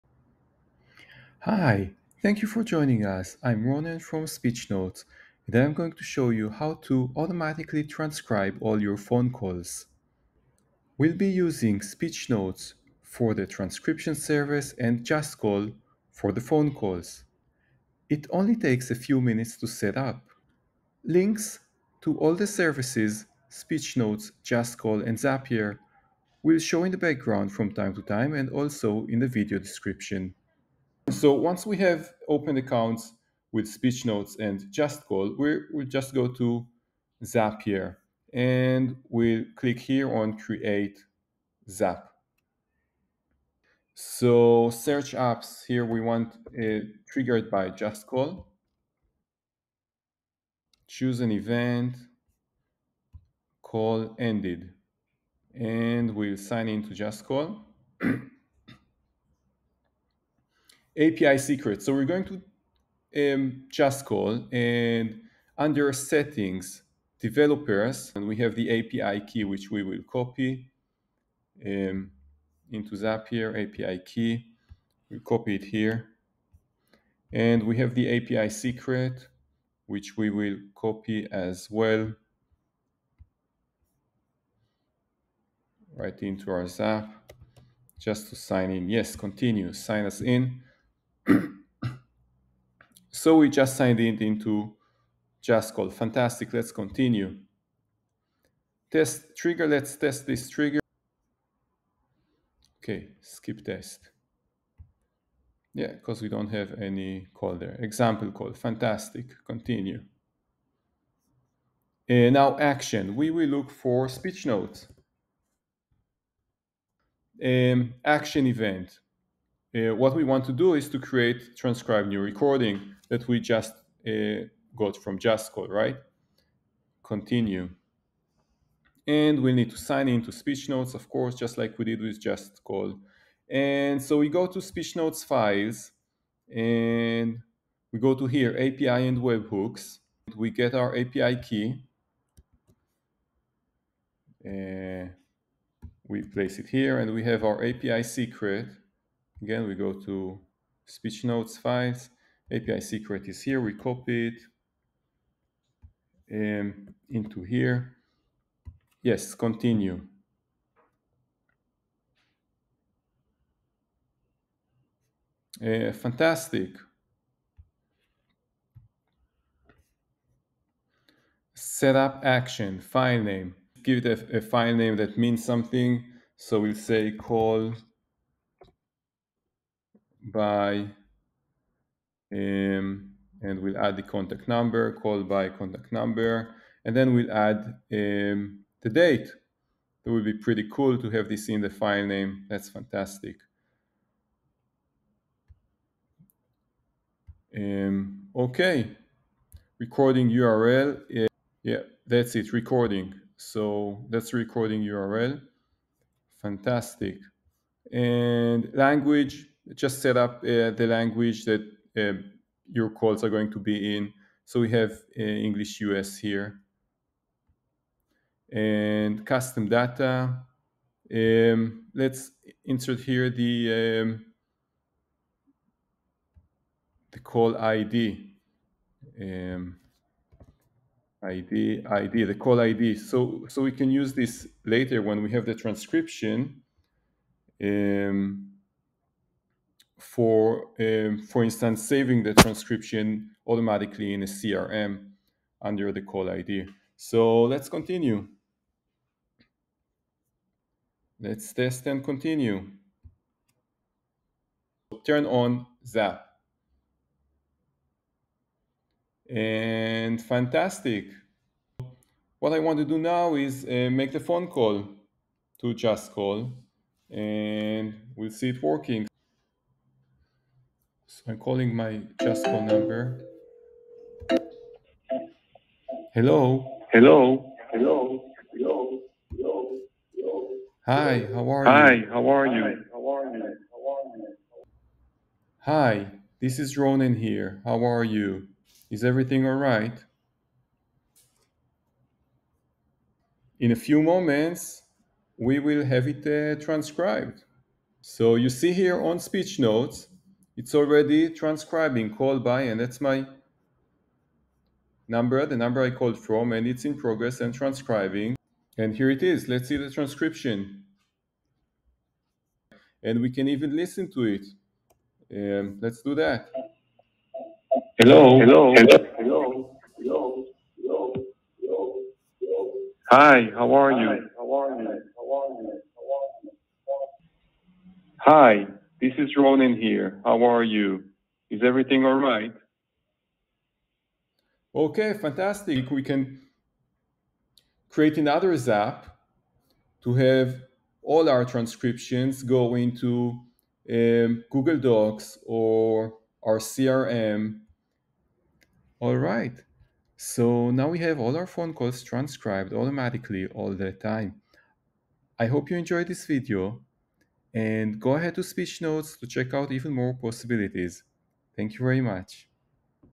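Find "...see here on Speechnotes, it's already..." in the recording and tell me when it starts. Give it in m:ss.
4:58.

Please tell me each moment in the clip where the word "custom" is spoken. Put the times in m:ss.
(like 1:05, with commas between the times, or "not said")
3:39.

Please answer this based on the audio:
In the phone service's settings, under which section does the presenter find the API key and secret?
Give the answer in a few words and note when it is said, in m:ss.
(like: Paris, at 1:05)
Developers, at 1:07.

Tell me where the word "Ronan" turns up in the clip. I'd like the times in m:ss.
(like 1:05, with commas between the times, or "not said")
0:03, 4:46, 5:29.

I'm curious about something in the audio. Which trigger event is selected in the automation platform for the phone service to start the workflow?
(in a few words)
Call ended.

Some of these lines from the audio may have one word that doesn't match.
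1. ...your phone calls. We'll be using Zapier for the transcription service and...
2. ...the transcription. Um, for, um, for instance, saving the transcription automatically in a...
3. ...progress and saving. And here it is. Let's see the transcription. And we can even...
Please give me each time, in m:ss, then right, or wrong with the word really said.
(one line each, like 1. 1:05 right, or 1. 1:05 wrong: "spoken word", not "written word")
1. 0:08 wrong: "Speechnotes", not "Zapier"
2. 3:55 right
3. 5:06 wrong: "transcribing", not "saving".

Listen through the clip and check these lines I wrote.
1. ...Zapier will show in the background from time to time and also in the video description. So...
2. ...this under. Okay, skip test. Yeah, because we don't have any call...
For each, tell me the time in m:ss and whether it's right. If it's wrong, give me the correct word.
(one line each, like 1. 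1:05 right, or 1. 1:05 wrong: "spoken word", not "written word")
1. 0:25 right
2. 1:40 wrong: "trigger", not "under".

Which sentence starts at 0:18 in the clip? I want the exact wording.
It only takes a few minutes to set up.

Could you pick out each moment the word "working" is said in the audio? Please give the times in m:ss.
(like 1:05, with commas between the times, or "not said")
4:28.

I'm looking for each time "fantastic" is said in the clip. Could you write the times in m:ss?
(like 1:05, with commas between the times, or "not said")
1:35, 1:48, 2:45, 3:12, 3:26, 4:20, 5:35.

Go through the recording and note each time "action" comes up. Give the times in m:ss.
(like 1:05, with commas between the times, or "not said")
1:52, 1:58, 2:52.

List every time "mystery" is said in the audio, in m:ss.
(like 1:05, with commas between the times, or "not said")
not said.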